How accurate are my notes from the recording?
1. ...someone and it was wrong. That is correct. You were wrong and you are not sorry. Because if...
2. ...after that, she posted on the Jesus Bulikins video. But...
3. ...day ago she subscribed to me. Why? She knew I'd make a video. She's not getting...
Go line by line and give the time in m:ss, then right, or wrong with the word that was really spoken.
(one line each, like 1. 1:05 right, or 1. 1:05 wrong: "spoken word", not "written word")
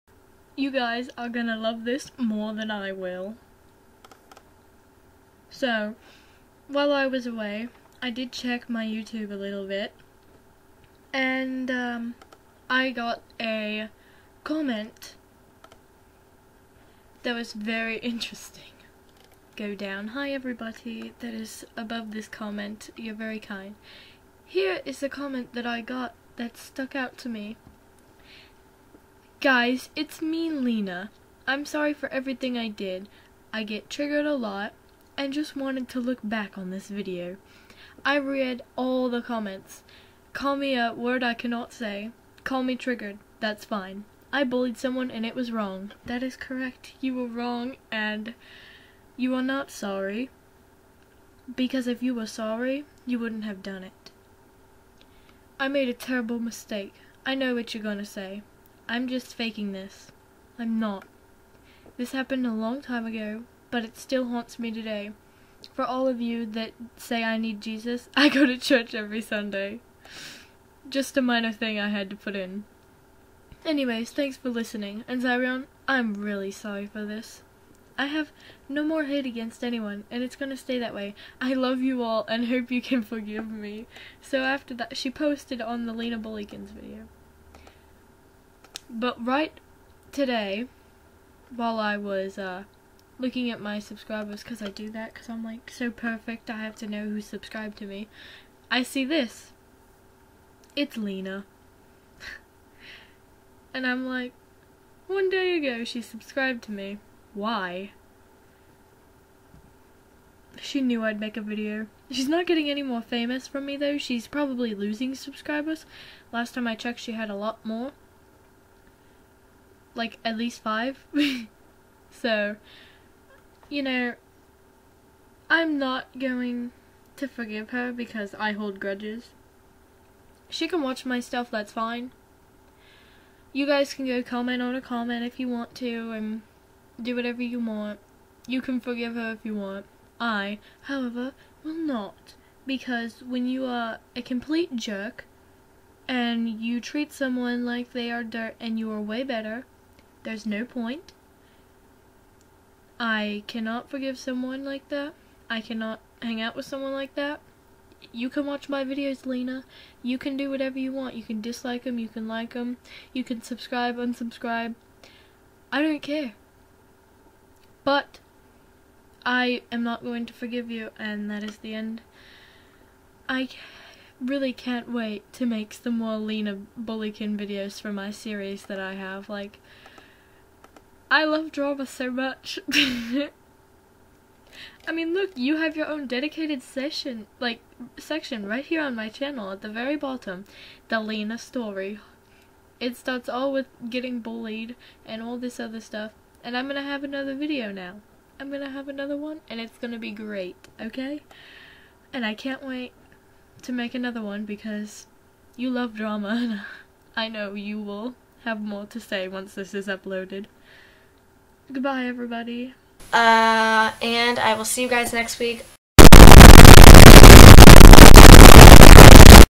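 1. 0:44 right
2. 1:24 wrong: "Lina", not "Jesus"
3. 1:45 right.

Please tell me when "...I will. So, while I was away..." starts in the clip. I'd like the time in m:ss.
0:02.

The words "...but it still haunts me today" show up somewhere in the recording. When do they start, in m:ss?
1:03.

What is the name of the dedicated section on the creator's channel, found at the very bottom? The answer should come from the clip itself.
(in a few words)
the Lina story.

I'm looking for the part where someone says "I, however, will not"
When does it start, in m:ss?
2:20.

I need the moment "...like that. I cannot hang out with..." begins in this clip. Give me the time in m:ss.
2:34.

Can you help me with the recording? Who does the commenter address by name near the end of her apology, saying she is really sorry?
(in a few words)
Zyrion.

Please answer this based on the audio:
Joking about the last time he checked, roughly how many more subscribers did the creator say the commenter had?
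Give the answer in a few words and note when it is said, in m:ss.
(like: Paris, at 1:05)
at least 5, at 2:00.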